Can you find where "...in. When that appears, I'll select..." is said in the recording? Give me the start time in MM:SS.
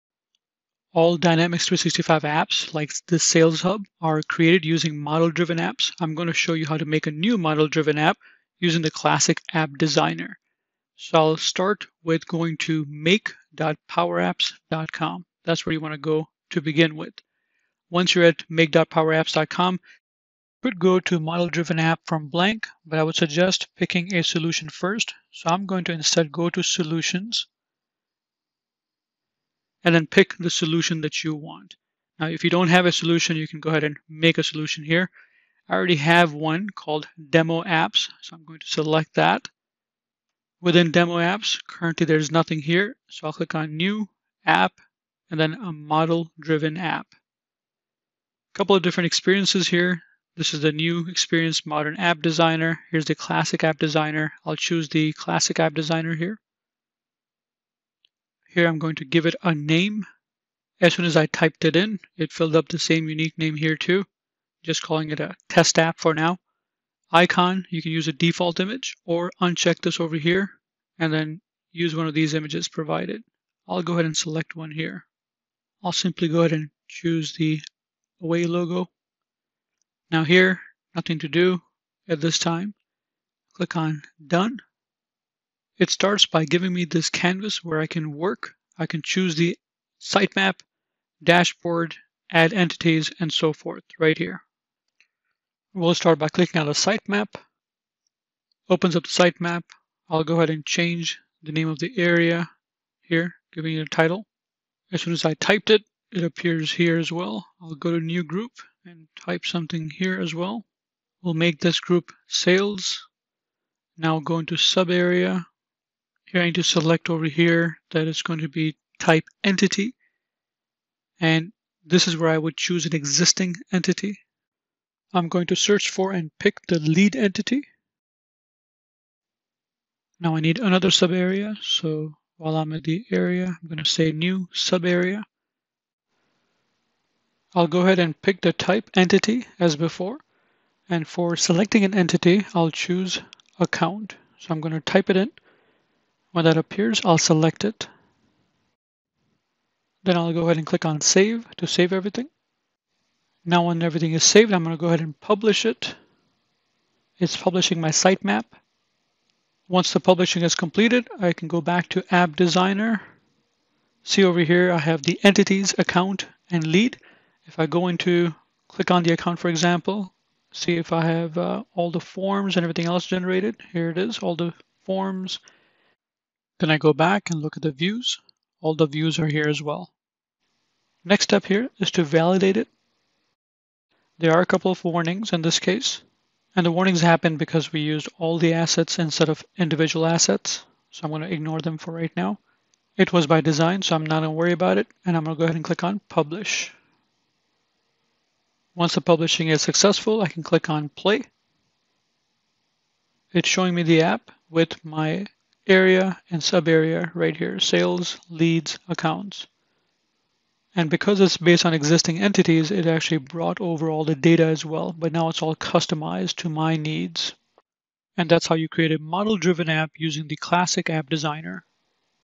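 02:25.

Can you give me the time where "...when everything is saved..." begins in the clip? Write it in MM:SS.
02:33.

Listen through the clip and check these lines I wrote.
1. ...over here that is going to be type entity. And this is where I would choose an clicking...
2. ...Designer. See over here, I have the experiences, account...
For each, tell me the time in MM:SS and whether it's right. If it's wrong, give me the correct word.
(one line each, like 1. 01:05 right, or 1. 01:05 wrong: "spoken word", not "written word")
1. 01:57 wrong: "existing", not "clicking"
2. 02:42 wrong: "entities", not "experiences".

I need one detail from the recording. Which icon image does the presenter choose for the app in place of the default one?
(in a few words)
away logo.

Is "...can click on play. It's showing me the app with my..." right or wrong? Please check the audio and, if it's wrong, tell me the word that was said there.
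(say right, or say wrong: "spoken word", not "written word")
right.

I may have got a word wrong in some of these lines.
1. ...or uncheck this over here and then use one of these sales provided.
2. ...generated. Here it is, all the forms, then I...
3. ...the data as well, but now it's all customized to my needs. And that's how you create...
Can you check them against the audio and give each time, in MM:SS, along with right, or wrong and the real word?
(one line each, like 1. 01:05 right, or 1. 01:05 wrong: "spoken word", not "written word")
1. 01:09 wrong: "images", not "sales"
2. 02:53 right
3. 03:34 right.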